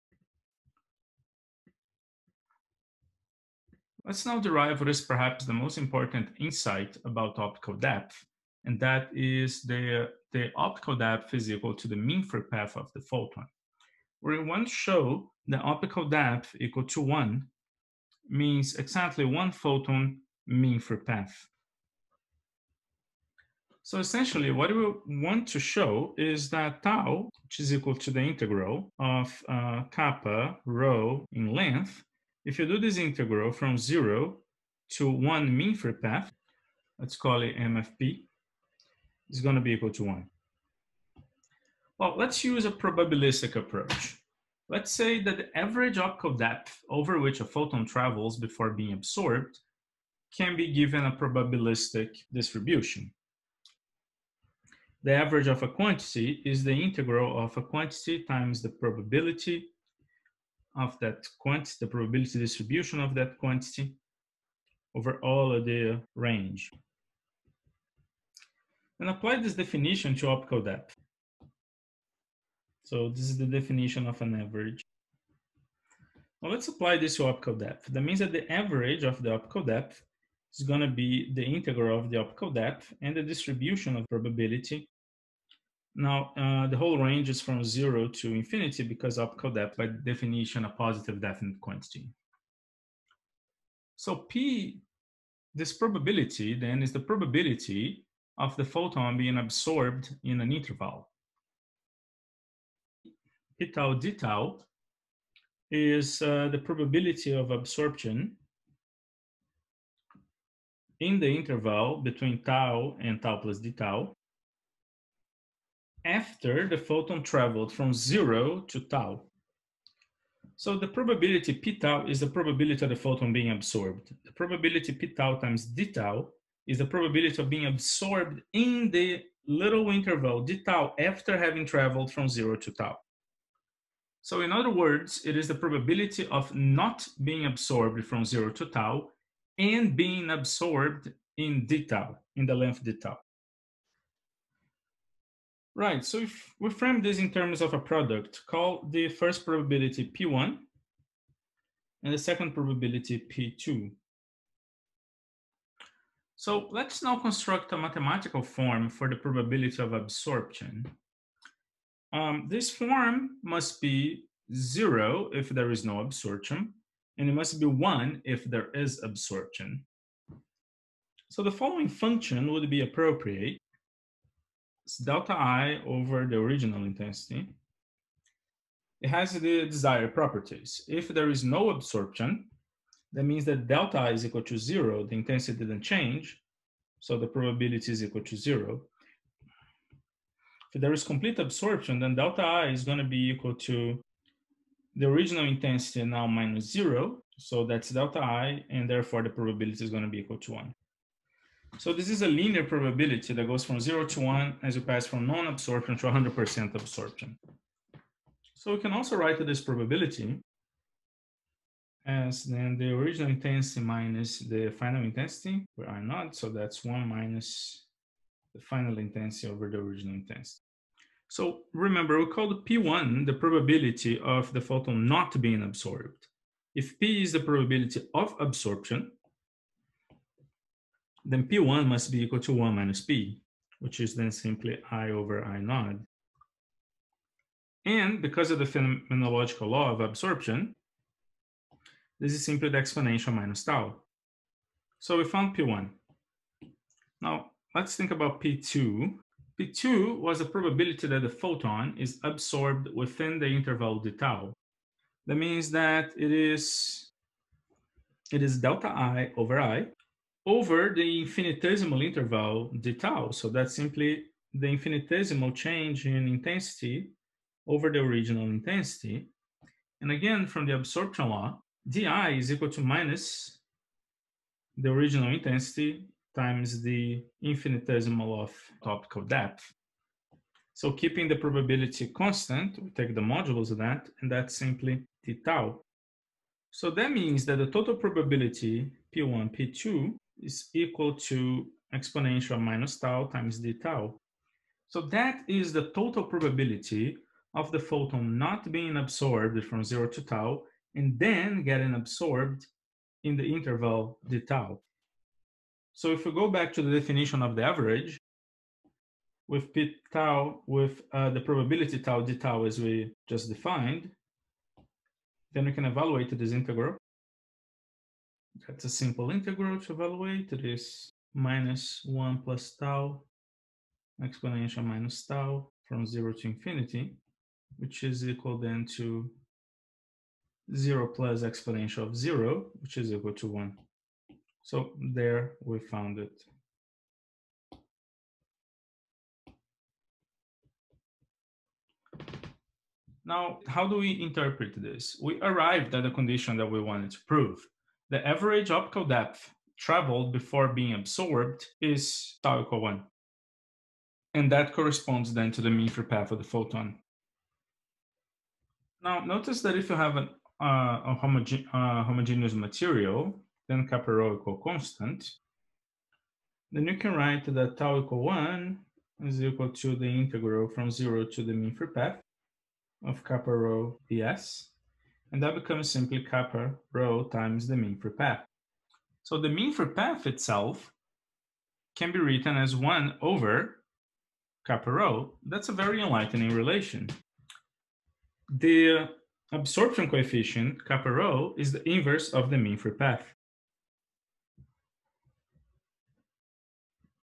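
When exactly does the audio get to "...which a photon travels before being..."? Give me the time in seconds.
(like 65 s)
47 s.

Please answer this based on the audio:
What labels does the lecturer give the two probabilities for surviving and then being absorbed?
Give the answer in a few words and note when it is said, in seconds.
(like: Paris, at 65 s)
P1 and P2, at 150 s.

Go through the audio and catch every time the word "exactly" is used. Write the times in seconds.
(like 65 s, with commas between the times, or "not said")
18 s.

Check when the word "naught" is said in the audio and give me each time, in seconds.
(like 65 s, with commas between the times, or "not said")
216 s, 235 s.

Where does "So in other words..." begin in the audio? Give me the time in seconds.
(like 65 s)
134 s.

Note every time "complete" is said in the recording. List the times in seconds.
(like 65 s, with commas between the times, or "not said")
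191 s.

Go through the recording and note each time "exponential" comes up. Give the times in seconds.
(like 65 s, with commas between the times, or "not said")
242 s, 291 s, 324 s, 331 s.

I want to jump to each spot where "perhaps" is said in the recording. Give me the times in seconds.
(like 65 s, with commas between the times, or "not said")
5 s.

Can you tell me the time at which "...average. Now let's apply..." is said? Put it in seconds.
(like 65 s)
74 s.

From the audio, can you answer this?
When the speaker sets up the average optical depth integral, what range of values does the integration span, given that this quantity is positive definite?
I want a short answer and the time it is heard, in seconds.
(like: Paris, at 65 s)
zero to infinity, at 87 s.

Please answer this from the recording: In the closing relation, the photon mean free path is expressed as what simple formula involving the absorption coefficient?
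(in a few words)
1 over kappa rho.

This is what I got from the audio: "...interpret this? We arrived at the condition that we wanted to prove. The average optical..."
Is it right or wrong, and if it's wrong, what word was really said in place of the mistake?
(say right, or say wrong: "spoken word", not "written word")
right.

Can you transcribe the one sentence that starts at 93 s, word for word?
So P, this probability then is the probability of the photon being absorbed in an interval.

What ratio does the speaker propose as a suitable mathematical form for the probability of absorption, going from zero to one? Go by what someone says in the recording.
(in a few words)
delta I over the original intensity.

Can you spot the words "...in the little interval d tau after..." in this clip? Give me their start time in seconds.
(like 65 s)
128 s.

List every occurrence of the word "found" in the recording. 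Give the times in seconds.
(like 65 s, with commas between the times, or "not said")
245 s, 335 s.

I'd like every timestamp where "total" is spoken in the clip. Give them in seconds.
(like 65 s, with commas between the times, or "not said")
287 s, 295 s.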